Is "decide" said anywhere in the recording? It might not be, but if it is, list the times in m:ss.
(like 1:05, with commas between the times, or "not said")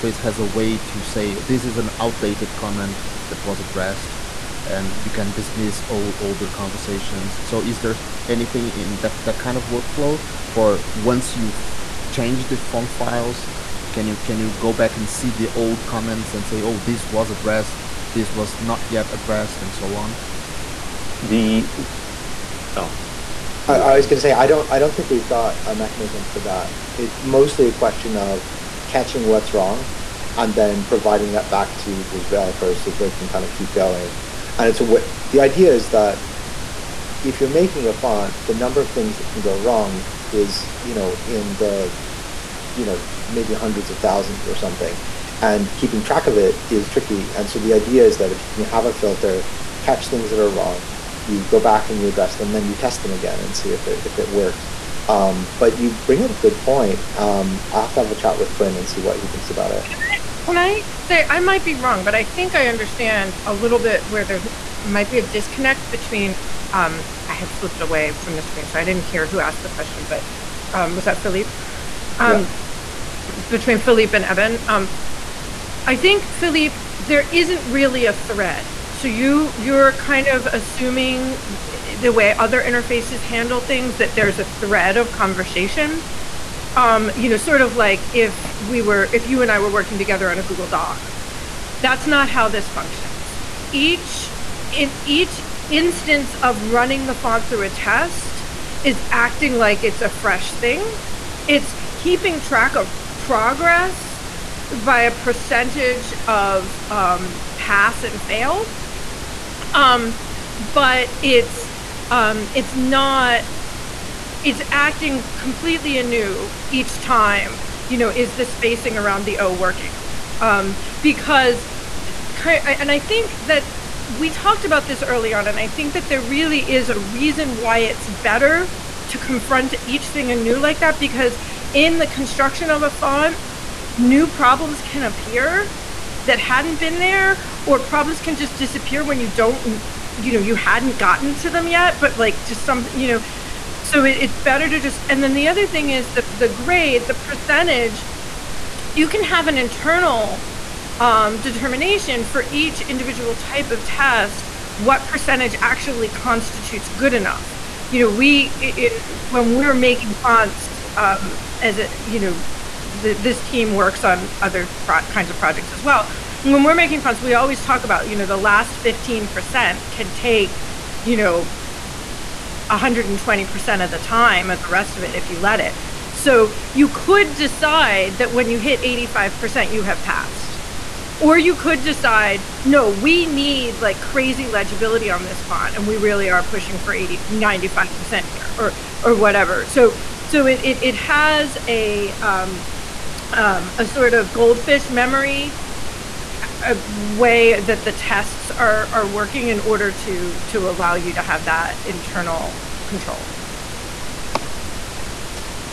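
2:57, 3:01.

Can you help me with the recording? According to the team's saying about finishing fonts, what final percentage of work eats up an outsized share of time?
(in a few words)
15%.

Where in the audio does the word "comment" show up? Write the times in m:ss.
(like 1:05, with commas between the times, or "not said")
0:02, 0:15.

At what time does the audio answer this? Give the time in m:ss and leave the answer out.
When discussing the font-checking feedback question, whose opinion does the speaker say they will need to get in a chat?
0:58.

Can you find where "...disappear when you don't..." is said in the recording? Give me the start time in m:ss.
2:18.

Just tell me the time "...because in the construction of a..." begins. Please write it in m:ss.
2:10.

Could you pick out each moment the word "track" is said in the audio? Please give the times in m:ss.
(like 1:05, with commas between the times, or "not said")
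0:46, 1:42.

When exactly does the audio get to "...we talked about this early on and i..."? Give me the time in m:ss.
2:04.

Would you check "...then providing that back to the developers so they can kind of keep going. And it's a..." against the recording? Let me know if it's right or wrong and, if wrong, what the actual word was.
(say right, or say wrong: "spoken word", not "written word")
right.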